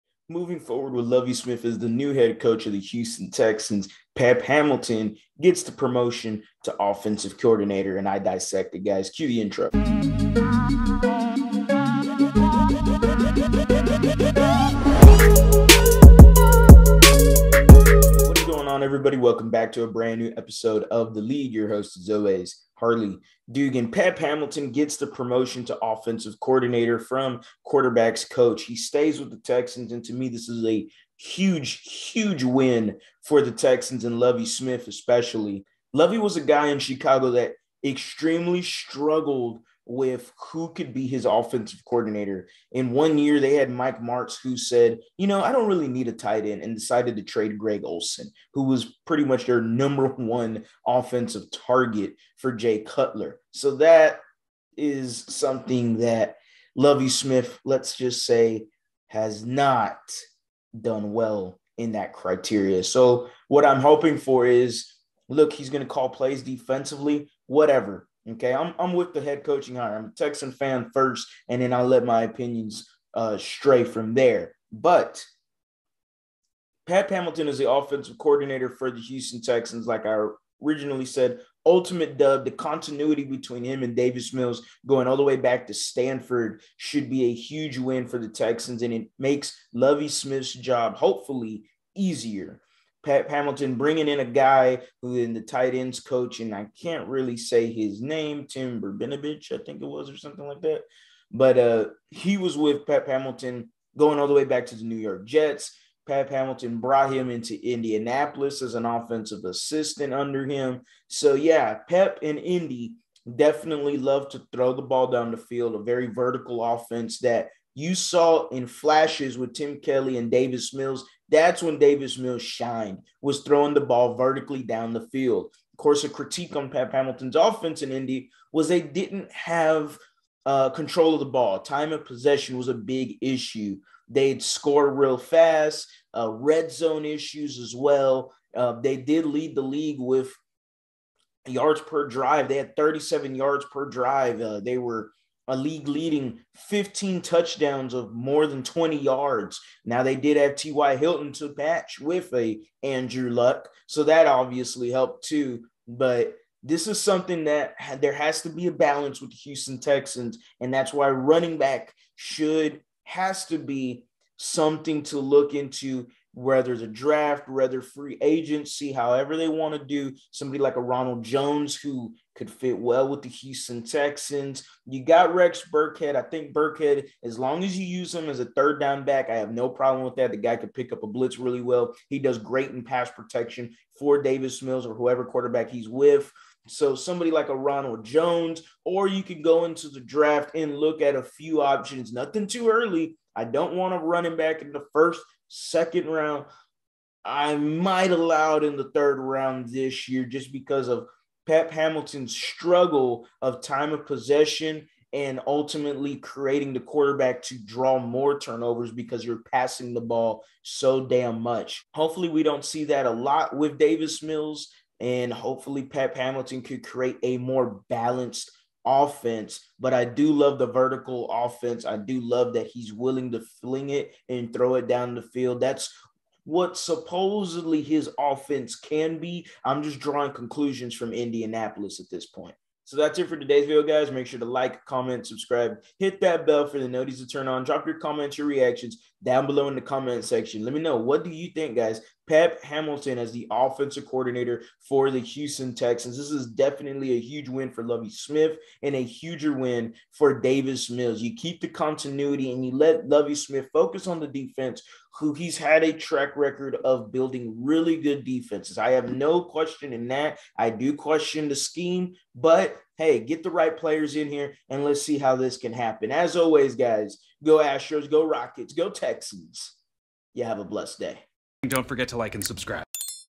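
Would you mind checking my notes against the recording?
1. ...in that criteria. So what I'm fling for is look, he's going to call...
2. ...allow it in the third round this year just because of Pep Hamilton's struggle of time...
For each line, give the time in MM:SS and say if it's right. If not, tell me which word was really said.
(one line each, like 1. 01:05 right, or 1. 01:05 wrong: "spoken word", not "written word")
1. 01:01 wrong: "hoping", not "fling"
2. 03:18 right.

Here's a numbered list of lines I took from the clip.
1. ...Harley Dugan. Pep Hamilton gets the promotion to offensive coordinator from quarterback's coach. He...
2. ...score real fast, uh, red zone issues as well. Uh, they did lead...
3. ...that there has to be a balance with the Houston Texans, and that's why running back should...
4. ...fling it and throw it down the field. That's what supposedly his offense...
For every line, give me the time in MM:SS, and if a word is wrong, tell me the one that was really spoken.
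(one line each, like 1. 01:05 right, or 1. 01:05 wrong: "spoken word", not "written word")
1. 00:22 right
2. 02:14 right
3. 02:37 right
4. 03:43 right.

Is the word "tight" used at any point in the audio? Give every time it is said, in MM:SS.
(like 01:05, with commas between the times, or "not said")
00:46, 01:35.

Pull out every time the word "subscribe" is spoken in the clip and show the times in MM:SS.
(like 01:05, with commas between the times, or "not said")
03:55, 04:32.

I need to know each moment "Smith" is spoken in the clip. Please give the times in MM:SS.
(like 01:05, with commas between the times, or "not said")
00:01, 00:34, 00:57, 01:30, 04:08, 04:13.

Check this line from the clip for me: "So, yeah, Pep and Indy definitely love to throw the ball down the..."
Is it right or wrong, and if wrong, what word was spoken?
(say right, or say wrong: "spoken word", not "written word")
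right.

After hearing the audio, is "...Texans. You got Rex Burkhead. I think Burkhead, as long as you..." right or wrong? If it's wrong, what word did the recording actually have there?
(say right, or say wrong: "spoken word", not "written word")
right.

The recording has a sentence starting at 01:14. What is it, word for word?
But Pat Hamilton is the offensive coordinator for the Houston Texans, like I originally said.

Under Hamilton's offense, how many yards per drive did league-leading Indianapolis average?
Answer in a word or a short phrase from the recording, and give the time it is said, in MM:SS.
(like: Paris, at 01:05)
37, at 02:22.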